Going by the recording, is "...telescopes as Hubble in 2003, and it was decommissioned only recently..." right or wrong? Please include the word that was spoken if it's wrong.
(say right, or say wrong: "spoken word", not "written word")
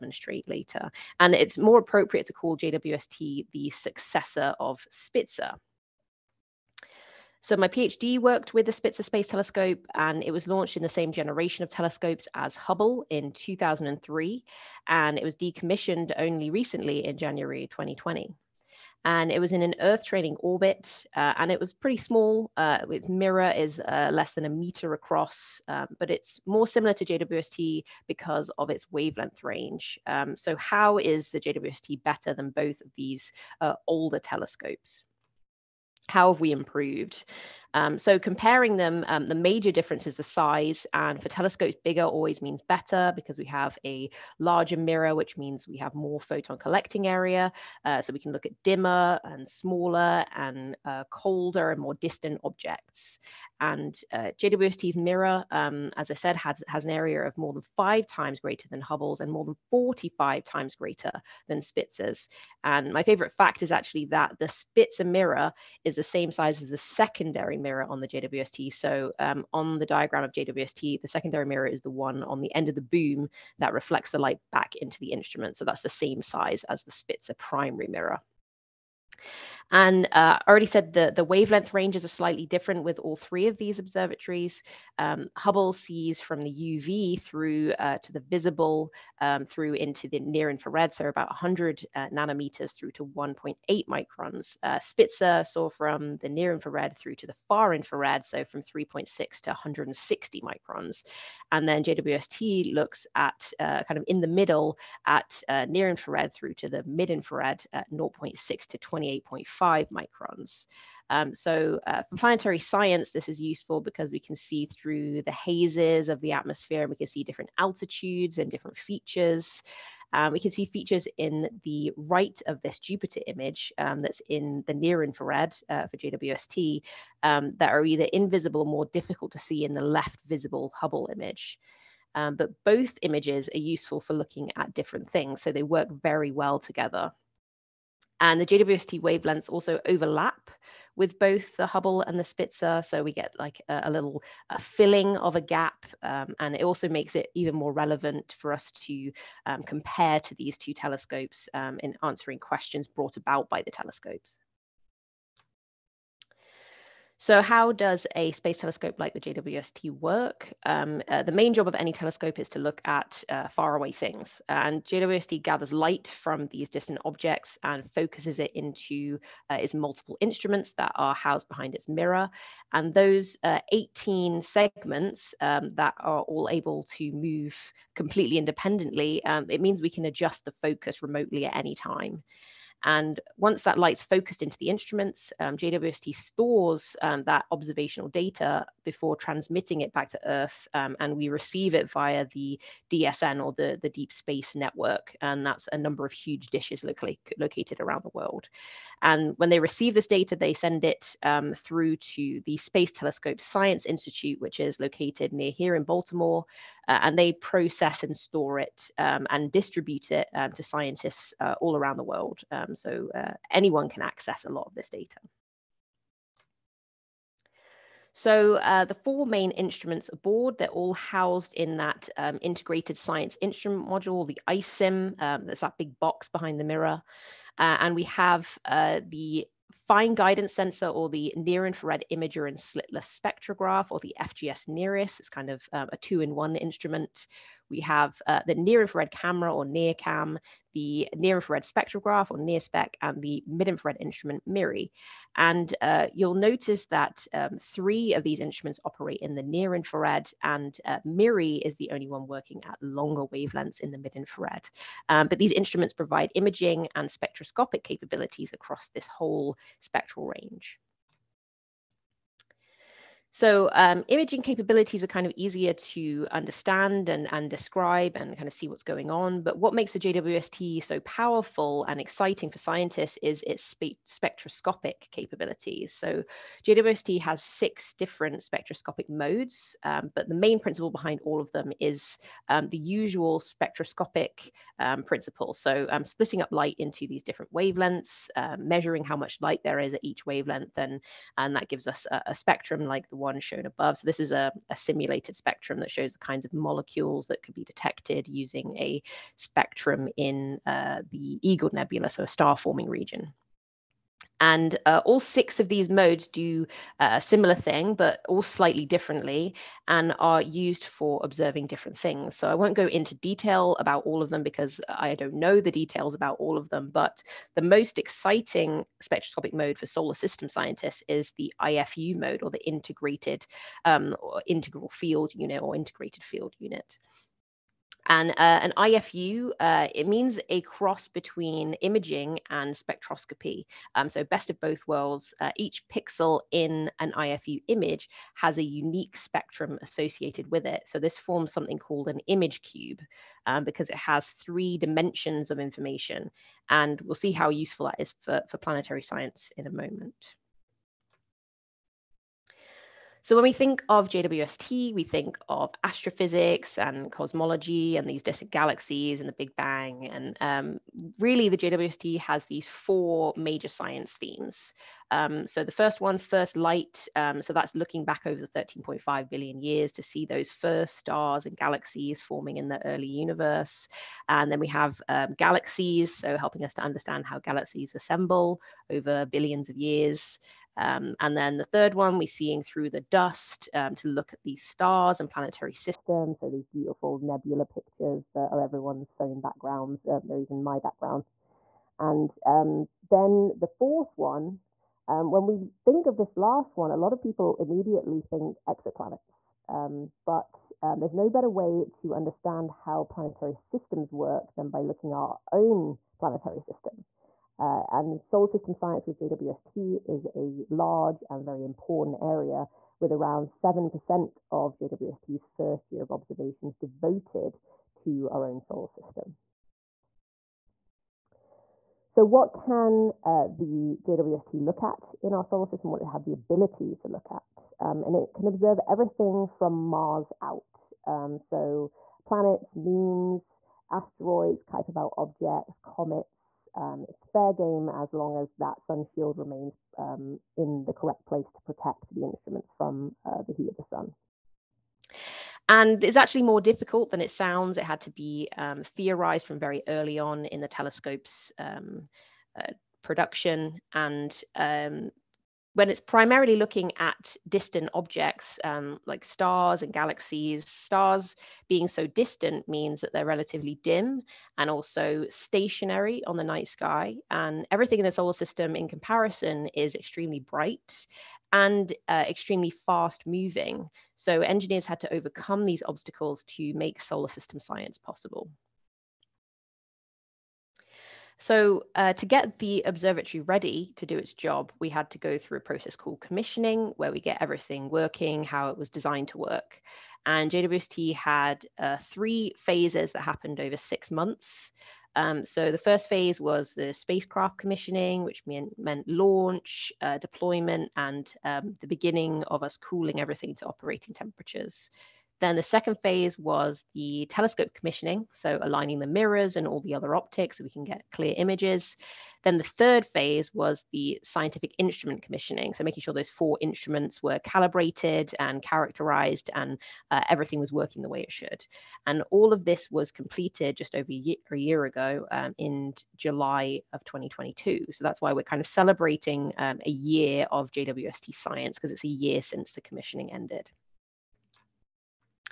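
right.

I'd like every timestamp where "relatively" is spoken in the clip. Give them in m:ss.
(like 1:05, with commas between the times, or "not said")
7:43.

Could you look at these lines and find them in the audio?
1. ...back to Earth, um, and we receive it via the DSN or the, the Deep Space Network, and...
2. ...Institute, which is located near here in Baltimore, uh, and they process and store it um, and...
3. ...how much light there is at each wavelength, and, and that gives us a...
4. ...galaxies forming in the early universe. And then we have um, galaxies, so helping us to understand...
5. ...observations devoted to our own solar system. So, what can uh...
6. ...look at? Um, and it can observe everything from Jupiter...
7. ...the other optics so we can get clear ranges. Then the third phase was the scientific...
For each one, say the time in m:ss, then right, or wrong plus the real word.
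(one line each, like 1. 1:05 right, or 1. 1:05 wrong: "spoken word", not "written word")
1. 3:09 right
2. 3:23 right
3. 4:49 right
4. 6:11 right
5. 6:56 right
6. 7:07 wrong: "Mars", not "Jupiter"
7. 8:29 wrong: "images", not "ranges".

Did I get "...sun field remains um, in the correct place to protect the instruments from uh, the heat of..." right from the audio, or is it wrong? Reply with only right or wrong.
wrong.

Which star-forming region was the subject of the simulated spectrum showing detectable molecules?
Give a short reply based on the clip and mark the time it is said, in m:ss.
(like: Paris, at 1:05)
Eagle Nebula, at 5:01.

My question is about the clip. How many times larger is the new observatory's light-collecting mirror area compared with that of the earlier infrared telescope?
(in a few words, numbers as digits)
45.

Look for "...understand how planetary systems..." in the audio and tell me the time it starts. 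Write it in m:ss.
6:42.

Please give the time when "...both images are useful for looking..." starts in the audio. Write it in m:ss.
2:12.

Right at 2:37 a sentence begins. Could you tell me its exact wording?
So how does a space telescope like the JWST work?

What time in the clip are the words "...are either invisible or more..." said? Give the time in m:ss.
2:07.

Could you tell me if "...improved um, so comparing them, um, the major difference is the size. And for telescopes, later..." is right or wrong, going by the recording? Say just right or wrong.
wrong.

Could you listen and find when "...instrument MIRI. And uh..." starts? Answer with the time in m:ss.
4:03.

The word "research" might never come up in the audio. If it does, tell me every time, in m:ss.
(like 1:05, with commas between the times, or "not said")
not said.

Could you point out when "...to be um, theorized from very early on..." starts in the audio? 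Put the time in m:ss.
7:28.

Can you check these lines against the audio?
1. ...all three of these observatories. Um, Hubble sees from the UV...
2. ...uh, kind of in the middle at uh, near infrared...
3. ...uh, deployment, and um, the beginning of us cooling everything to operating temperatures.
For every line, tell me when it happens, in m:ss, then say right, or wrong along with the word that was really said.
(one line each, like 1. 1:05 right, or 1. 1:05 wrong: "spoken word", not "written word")
1. 1:22 right
2. 1:43 right
3. 8:20 right.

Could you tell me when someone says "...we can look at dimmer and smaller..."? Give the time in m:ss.
0:48.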